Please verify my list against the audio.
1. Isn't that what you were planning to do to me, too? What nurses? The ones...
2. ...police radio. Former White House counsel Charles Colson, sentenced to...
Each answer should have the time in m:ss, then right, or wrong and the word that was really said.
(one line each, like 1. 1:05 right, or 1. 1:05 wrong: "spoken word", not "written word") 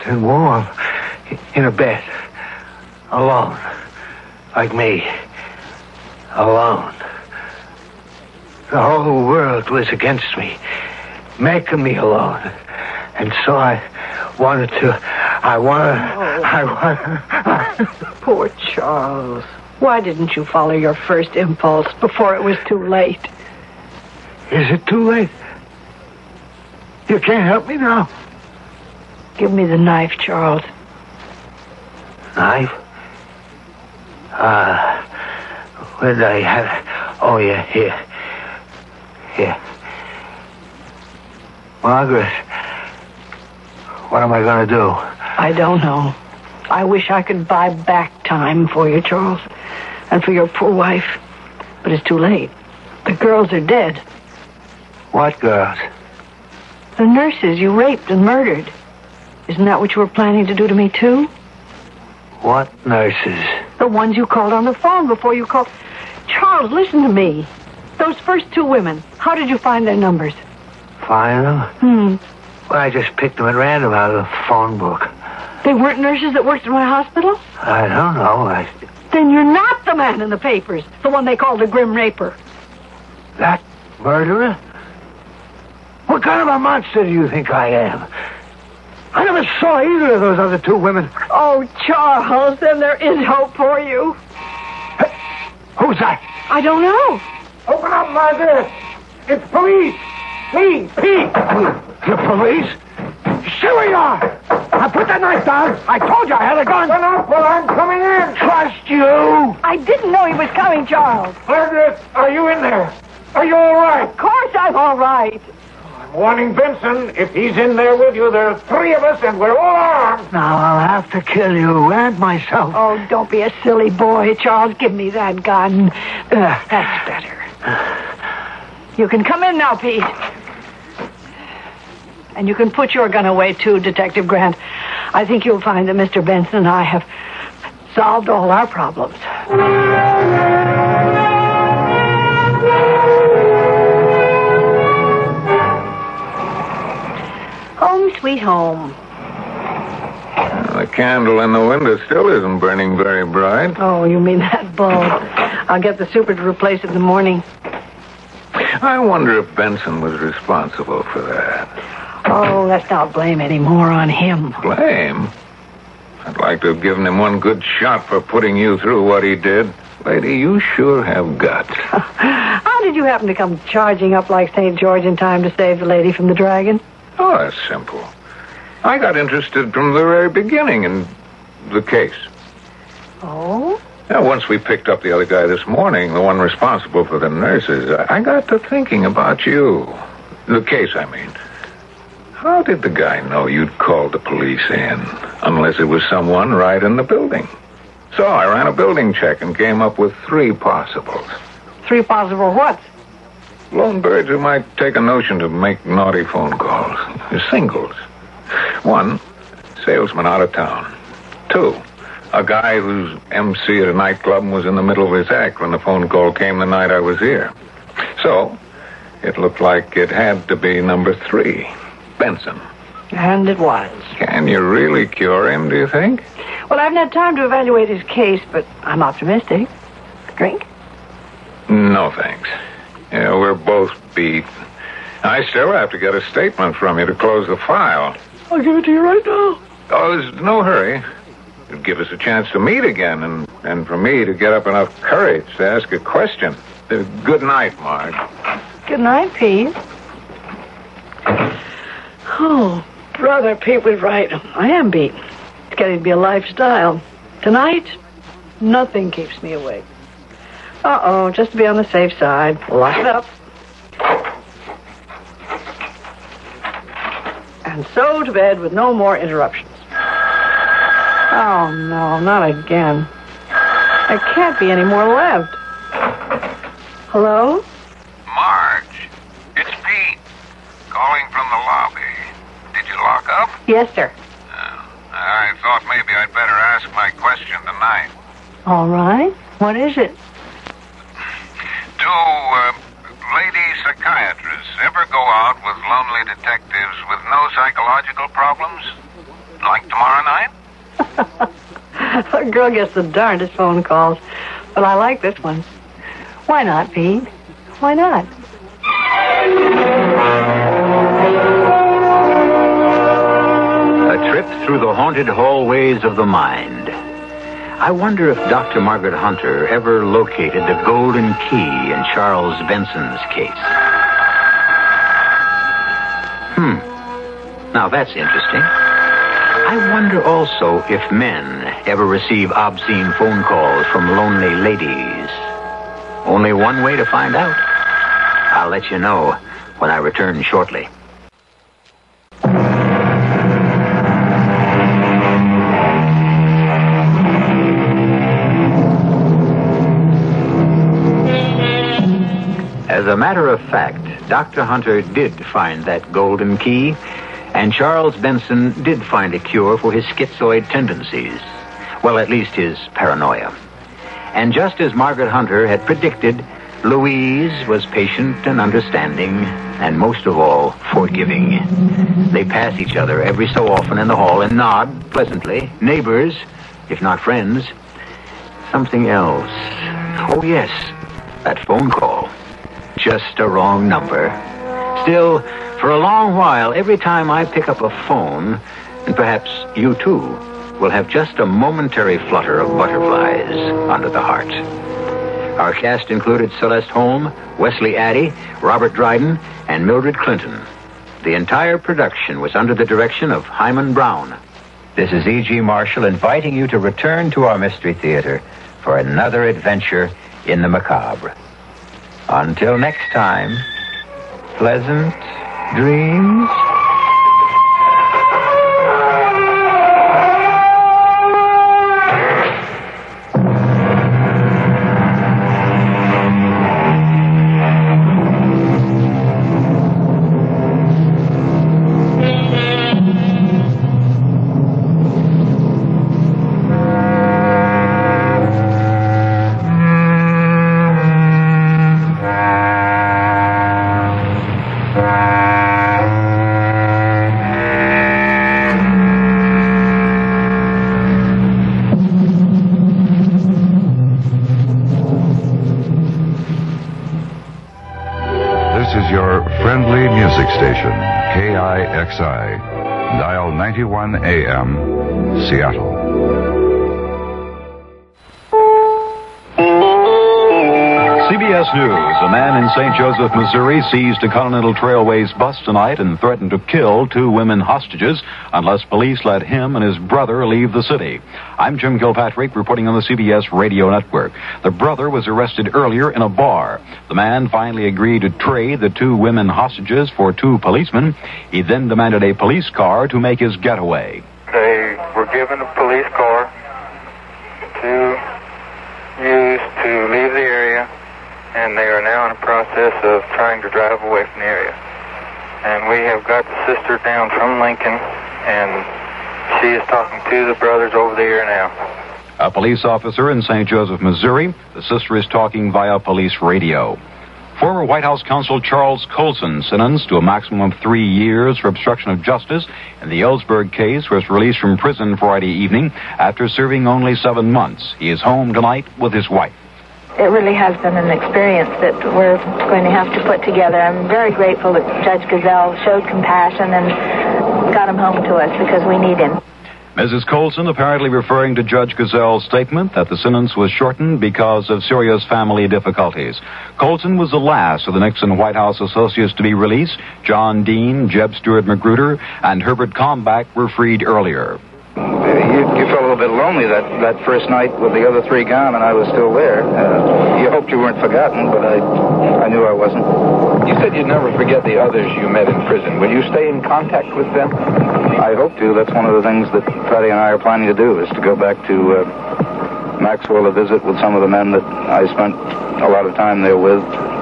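1. 0:59 right
2. 8:35 right.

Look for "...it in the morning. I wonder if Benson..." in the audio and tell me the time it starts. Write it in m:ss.
2:36.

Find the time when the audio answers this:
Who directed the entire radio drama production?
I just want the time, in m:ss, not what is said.
6:43.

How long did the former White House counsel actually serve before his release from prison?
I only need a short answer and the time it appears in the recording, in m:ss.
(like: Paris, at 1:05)
7 months, at 8:47.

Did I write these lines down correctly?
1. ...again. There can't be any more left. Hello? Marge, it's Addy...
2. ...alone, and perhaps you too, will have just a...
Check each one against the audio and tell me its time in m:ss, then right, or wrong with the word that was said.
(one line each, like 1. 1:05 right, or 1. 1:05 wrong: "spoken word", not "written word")
1. 4:32 wrong: "Pete", not "Addy"
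2. 6:28 wrong: "phone", not "alone".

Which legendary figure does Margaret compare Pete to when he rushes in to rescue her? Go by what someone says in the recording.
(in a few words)
St. George.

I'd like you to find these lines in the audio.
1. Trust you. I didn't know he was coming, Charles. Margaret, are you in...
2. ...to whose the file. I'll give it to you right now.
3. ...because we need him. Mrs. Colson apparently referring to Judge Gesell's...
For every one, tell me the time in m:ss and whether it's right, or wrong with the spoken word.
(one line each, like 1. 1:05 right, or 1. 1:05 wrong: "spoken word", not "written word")
1. 1:48 right
2. 3:57 wrong: "close", not "whose"
3. 8:58 right.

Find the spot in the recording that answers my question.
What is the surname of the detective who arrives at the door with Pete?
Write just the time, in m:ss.
2:14.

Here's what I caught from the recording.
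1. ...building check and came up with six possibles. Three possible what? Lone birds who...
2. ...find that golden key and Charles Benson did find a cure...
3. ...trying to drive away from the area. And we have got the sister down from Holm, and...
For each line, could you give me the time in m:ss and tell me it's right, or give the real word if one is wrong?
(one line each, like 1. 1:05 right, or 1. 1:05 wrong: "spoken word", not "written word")
1. 3:18 wrong: "three", not "six"
2. 5:55 right
3. 8:23 wrong: "Lincoln", not "Holm".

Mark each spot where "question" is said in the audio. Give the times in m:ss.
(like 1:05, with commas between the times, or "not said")
4:05, 4:47.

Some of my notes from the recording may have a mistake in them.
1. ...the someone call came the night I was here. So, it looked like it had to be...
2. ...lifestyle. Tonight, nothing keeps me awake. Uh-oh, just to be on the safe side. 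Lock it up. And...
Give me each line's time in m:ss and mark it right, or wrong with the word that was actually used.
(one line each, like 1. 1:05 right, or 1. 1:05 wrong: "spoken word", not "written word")
1. 3:35 wrong: "phone", not "someone"
2. 4:16 right.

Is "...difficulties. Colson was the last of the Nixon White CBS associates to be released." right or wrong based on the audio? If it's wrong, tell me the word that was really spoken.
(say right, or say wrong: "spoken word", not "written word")
wrong: "House", not "CBS".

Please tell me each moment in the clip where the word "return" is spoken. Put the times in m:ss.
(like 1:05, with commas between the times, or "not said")
5:39, 6:46.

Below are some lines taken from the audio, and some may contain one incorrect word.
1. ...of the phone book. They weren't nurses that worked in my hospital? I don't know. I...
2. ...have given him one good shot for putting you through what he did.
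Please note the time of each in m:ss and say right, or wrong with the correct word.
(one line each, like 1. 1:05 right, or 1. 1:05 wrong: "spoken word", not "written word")
1. 1:14 right
2. 2:46 right.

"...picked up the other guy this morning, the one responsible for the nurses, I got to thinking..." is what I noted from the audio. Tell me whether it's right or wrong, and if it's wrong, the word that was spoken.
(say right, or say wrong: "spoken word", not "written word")
right.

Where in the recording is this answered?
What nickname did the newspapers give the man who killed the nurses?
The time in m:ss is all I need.
1:21.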